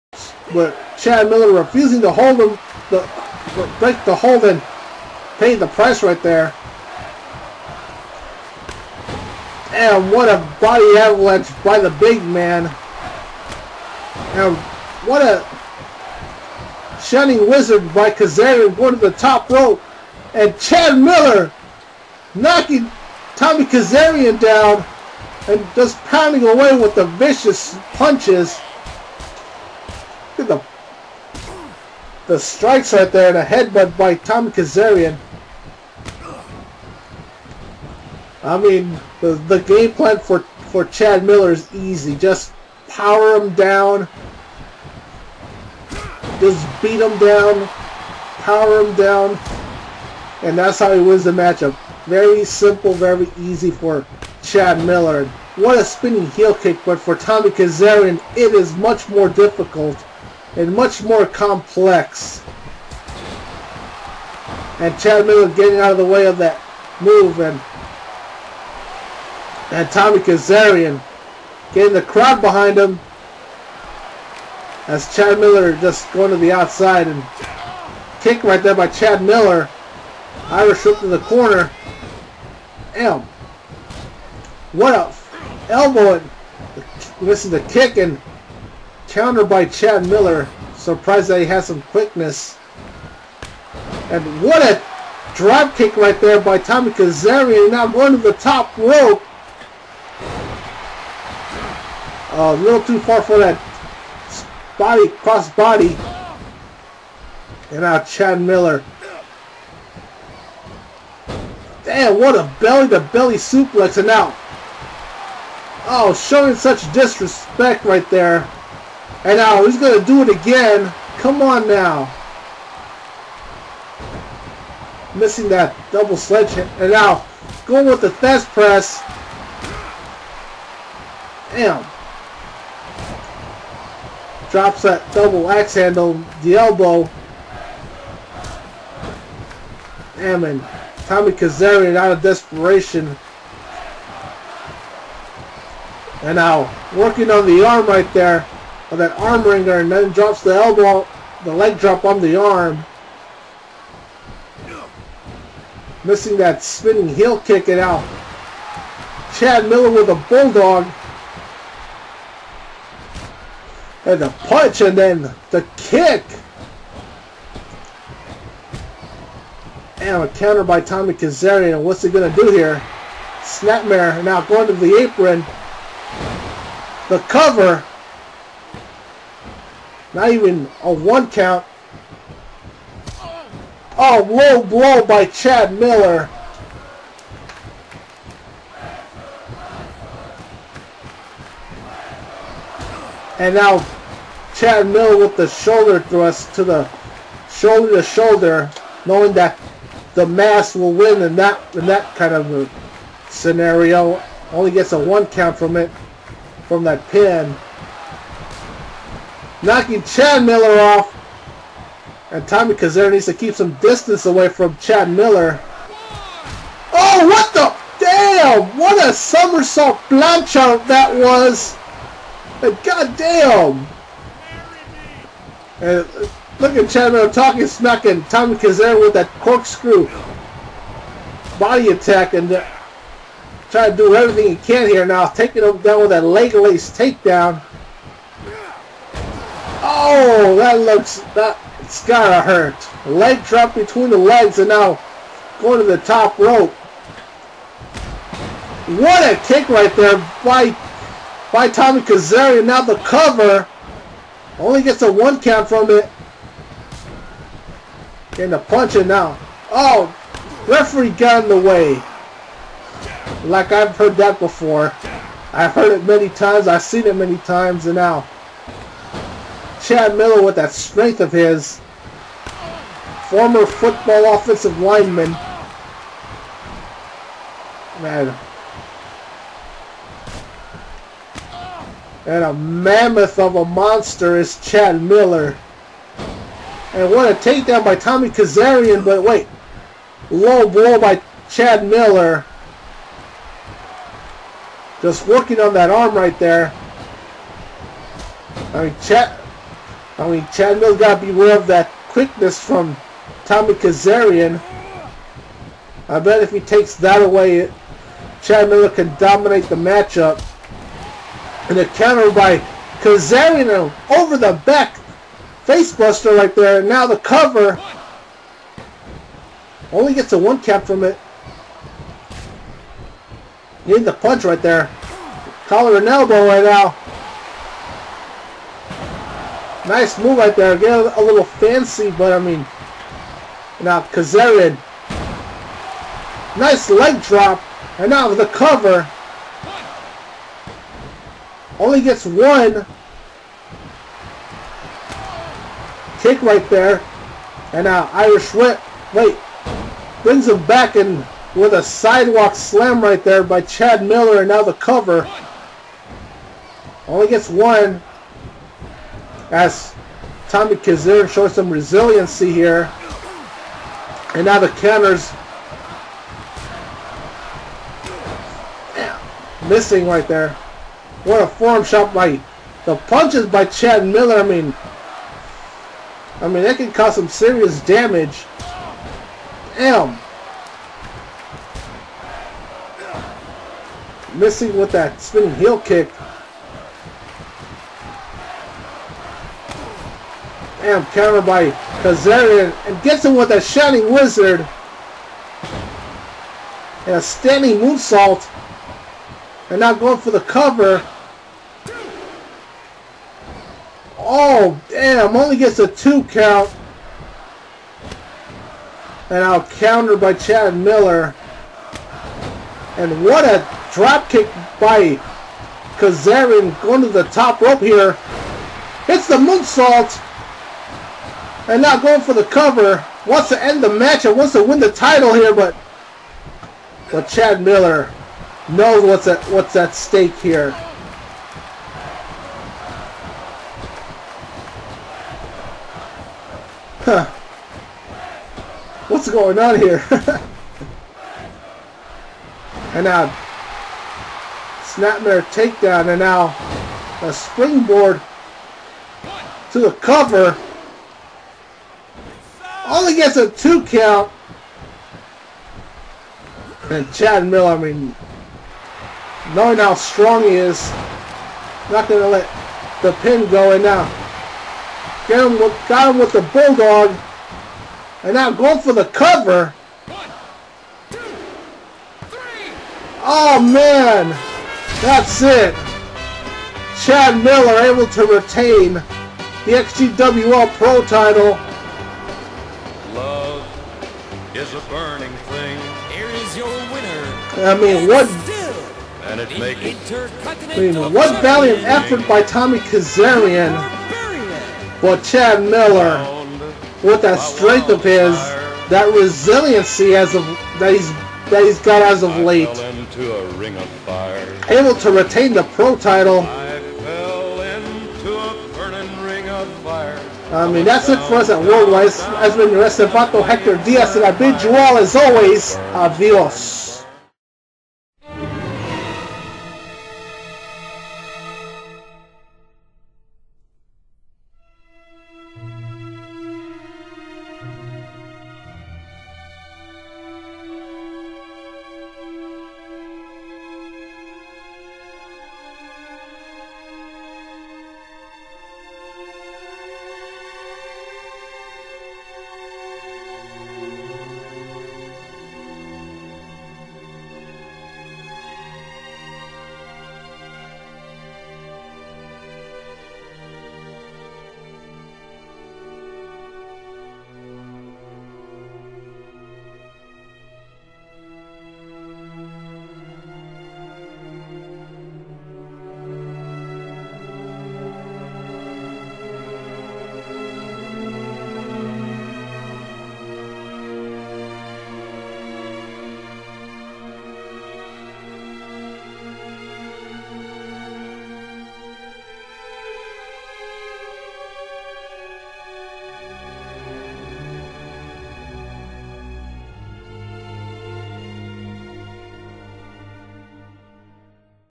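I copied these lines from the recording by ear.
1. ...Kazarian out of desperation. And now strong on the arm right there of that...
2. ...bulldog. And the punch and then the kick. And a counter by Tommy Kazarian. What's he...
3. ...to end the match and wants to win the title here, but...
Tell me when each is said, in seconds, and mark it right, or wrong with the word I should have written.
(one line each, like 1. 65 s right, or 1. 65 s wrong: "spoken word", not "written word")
1. 141 s wrong: "working", not "strong"
2. 160 s right
3. 423 s right.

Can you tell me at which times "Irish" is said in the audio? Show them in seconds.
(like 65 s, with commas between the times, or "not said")
80 s, 348 s.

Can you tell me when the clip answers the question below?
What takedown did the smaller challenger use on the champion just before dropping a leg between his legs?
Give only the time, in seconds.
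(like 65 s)
236 s.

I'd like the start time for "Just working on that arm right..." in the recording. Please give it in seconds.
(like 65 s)
295 s.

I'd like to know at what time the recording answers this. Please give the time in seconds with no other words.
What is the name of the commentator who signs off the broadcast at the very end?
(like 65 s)
513 s.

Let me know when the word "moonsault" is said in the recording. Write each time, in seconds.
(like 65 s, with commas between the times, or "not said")
397 s, 419 s.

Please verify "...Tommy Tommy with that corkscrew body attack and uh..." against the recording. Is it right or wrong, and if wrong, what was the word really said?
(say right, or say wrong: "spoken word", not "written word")
wrong: "Kazare", not "Tommy".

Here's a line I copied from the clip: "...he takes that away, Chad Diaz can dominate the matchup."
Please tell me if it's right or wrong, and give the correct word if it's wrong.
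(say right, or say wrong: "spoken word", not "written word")
wrong: "Miller", not "Diaz".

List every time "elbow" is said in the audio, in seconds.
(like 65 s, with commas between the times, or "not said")
85 s, 136 s, 150 s, 326 s.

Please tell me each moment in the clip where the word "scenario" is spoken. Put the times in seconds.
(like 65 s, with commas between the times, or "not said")
203 s.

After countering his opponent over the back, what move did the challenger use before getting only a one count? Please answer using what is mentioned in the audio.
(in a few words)
Facebuster.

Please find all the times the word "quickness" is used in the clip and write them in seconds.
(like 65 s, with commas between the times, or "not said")
91 s, 302 s.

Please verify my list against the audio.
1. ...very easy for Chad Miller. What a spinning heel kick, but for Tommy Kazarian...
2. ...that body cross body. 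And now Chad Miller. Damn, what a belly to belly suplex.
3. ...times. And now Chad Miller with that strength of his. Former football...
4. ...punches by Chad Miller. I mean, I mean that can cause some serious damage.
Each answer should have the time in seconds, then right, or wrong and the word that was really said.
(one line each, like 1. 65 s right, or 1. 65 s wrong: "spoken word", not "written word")
1. 52 s right
2. 103 s right
3. 267 s right
4. 373 s right.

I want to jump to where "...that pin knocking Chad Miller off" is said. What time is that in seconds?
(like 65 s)
206 s.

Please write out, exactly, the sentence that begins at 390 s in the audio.
Amp Counter by Kazarian and gets him with a Shining Wizard.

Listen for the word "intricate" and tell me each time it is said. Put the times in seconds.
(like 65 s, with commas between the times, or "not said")
not said.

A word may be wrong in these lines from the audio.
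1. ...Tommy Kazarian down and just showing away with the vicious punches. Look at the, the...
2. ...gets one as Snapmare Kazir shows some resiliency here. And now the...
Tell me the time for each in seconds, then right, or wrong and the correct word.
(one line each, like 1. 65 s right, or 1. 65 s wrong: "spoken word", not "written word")
1. 23 s wrong: "pounding", not "showing"
2. 357 s wrong: "Tommy", not "Snapmare".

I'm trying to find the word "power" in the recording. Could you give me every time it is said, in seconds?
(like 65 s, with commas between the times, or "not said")
42 s, 47 s.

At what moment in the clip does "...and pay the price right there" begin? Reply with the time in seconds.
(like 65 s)
4 s.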